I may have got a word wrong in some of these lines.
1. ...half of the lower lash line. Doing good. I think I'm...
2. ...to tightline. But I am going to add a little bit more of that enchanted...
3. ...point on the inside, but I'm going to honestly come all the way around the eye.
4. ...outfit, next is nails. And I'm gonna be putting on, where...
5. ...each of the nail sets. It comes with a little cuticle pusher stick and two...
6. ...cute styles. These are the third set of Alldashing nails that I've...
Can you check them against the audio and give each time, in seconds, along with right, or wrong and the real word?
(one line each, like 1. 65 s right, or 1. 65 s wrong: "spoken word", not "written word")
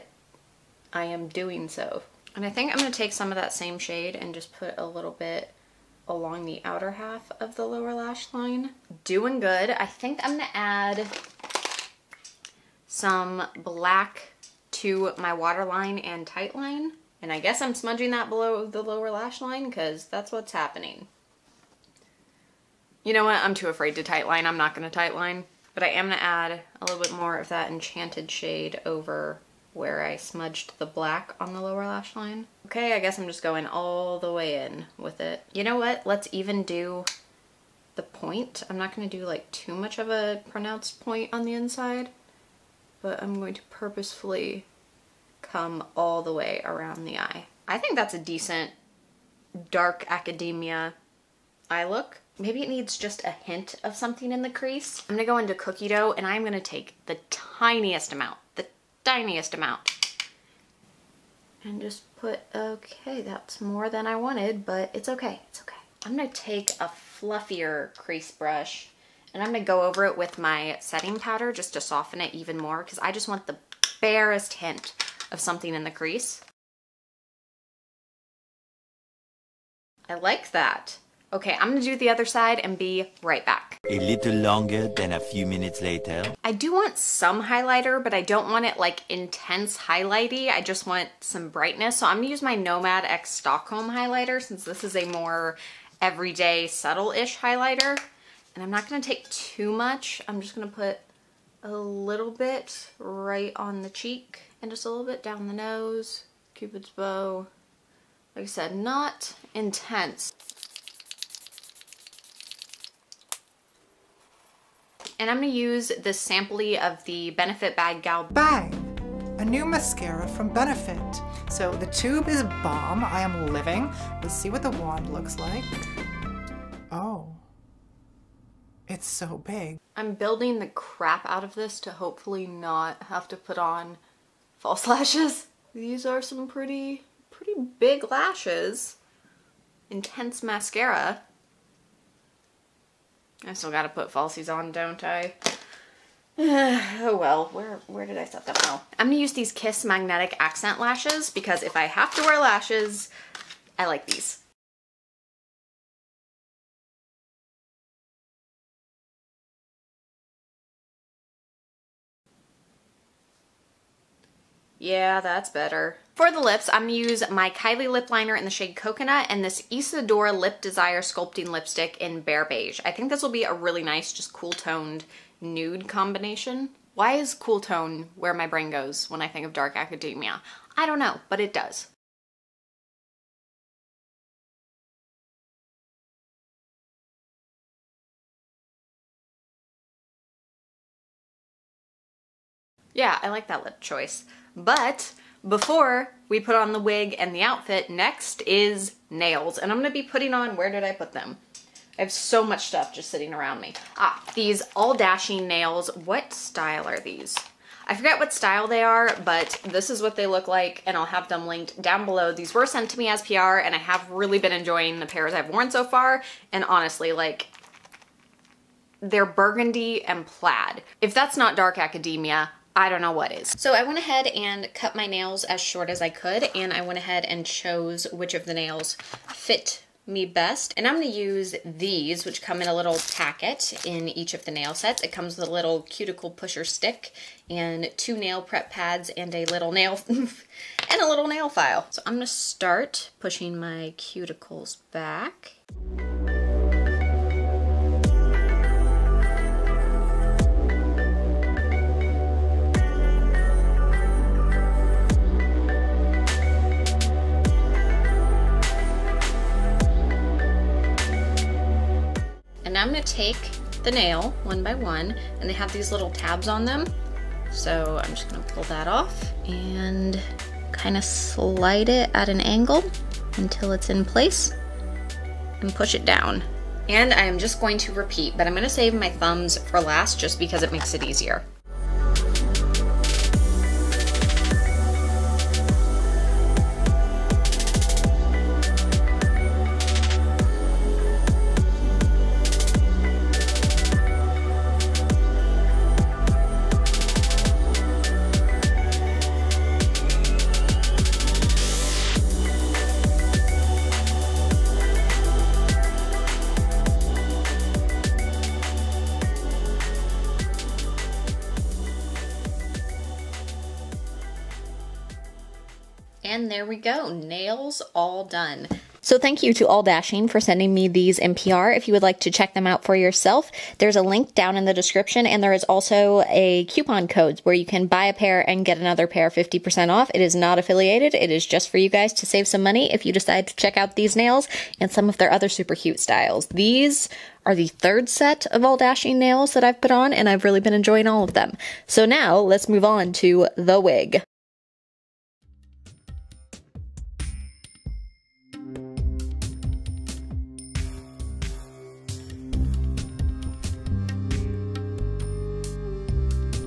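1. 6 s right
2. 24 s right
3. 40 s wrong: "purposefully", not "honestly"
4. 197 s right
5. 234 s right
6. 335 s right.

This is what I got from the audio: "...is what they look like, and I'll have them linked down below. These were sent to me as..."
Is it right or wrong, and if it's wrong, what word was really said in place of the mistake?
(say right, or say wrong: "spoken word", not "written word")
right.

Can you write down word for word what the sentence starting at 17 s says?
And I guess I'm smudging that below the lower lash line because that's what's happening.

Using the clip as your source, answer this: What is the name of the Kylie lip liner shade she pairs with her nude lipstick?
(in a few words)
Coconut.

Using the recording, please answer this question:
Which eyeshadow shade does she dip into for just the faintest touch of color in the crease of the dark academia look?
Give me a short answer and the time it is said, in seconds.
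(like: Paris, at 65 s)
Cookie Dough, at 55 s.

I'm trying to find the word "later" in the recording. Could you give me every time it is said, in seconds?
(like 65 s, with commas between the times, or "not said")
85 s.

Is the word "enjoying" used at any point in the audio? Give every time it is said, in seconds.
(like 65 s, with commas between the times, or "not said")
214 s, 340 s.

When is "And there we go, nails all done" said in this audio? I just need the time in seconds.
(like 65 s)
316 s.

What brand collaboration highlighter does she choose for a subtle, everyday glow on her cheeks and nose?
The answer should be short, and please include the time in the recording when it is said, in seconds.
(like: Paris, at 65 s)
Nomad X Stockholm, at 92 s.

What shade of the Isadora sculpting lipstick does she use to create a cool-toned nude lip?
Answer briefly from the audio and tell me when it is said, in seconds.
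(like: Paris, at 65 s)
Bare Beige, at 172 s.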